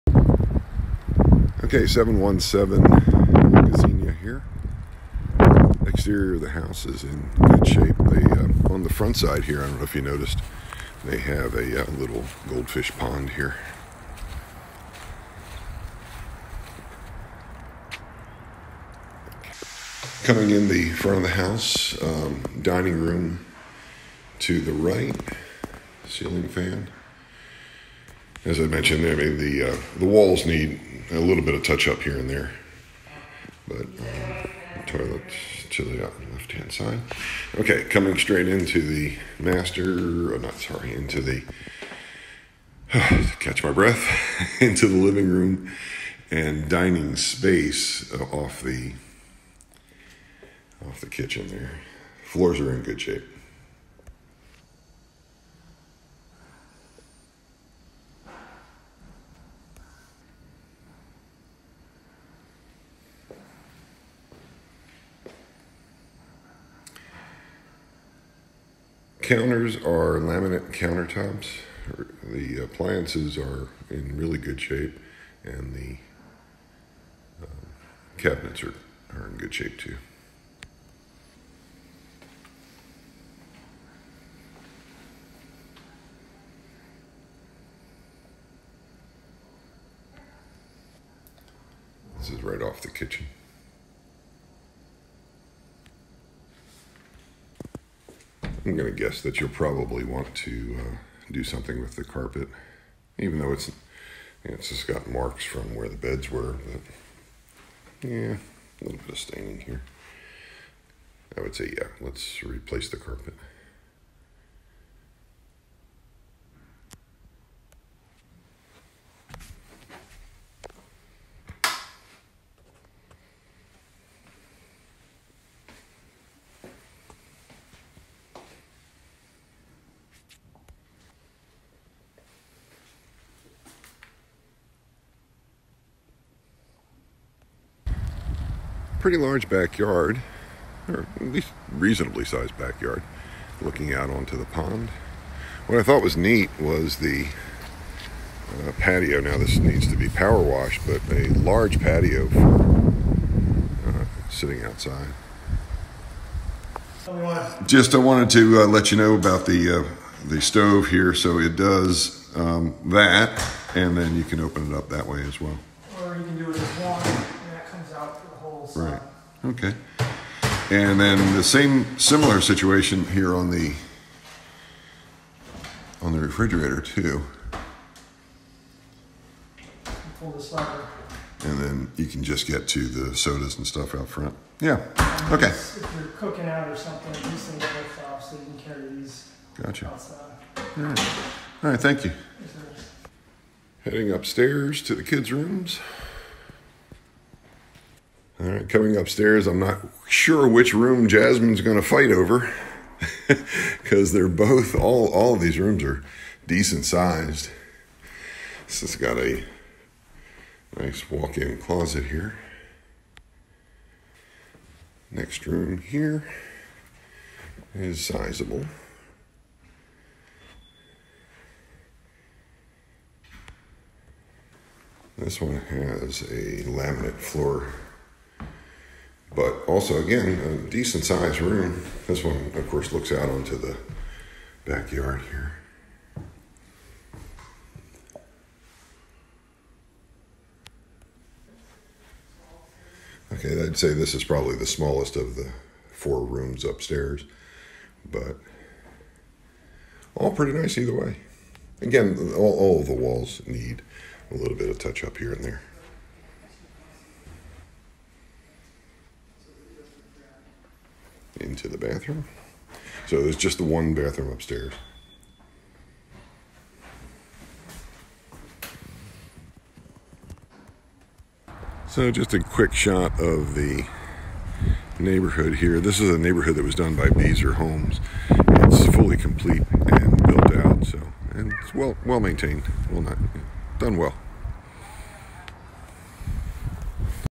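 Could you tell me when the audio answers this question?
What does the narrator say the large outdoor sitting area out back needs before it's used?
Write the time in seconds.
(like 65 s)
150 s.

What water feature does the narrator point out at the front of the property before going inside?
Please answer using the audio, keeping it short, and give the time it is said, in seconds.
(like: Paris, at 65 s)
goldfish pond, at 12 s.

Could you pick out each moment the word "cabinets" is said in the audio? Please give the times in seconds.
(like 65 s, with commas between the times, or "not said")
78 s.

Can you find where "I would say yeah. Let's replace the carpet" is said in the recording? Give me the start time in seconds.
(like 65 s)
111 s.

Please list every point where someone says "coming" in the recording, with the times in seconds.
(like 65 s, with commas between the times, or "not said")
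20 s, 37 s, 198 s.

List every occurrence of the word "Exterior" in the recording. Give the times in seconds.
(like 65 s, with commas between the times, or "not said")
5 s.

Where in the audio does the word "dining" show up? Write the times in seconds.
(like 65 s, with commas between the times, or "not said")
22 s, 46 s.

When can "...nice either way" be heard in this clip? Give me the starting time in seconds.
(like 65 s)
250 s.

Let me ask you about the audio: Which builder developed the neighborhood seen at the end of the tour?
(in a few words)
Beazer Homes.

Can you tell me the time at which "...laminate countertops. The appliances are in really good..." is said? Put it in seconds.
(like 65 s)
70 s.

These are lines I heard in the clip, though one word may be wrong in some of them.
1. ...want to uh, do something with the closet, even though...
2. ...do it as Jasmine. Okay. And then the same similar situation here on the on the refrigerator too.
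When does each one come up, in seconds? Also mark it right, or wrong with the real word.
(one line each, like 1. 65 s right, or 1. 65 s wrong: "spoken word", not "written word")
1. 100 s wrong: "carpet", not "closet"
2. 166 s wrong: "Right", not "Jasmine".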